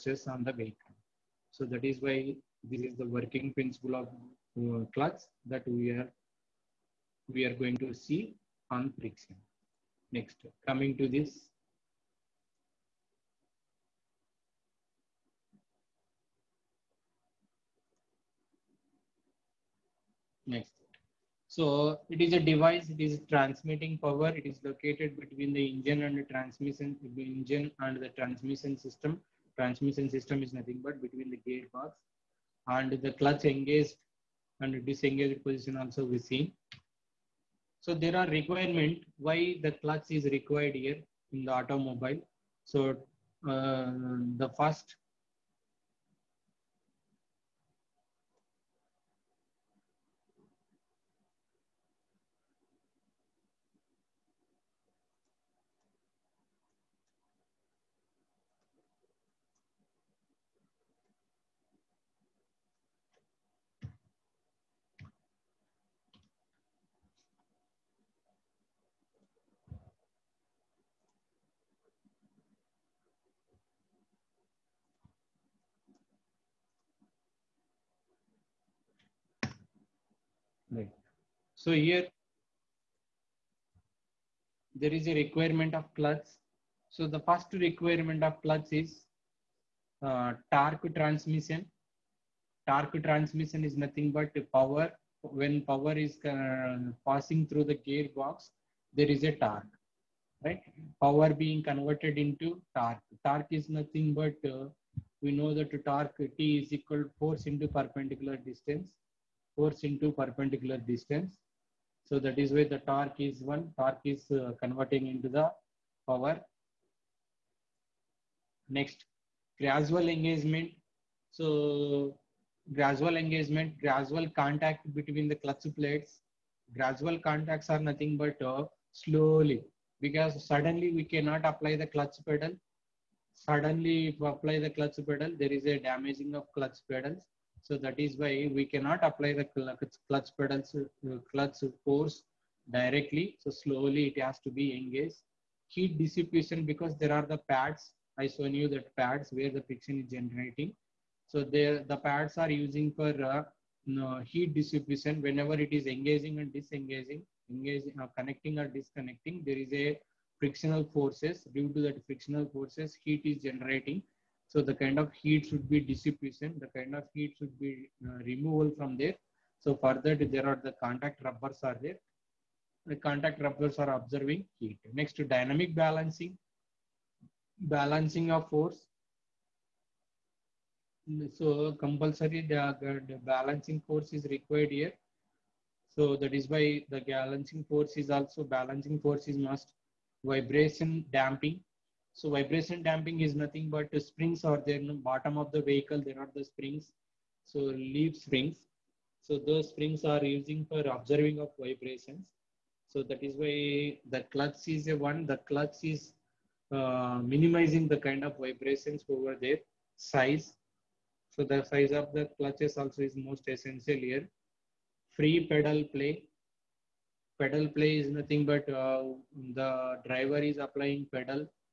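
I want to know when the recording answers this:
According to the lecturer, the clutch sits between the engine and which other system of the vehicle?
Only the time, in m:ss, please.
0:27.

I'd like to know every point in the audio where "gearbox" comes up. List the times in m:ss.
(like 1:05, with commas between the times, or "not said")
0:31, 1:37.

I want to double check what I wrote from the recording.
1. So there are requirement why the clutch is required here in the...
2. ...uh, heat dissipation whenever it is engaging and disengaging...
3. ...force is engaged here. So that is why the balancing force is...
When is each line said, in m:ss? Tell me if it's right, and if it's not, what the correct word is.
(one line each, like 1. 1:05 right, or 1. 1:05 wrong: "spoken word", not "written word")
1. 0:37 right
2. 2:33 right
3. 3:03 wrong: "required", not "engaged".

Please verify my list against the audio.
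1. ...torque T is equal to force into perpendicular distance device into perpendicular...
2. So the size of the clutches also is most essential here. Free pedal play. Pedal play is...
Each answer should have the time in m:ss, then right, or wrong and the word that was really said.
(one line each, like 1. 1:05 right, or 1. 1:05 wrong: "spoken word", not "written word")
1. 1:45 wrong: "force", not "device"
2. 3:31 right.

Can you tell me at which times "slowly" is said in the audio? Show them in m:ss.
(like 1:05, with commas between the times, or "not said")
2:08, 2:23.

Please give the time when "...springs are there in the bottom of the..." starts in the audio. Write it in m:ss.
3:13.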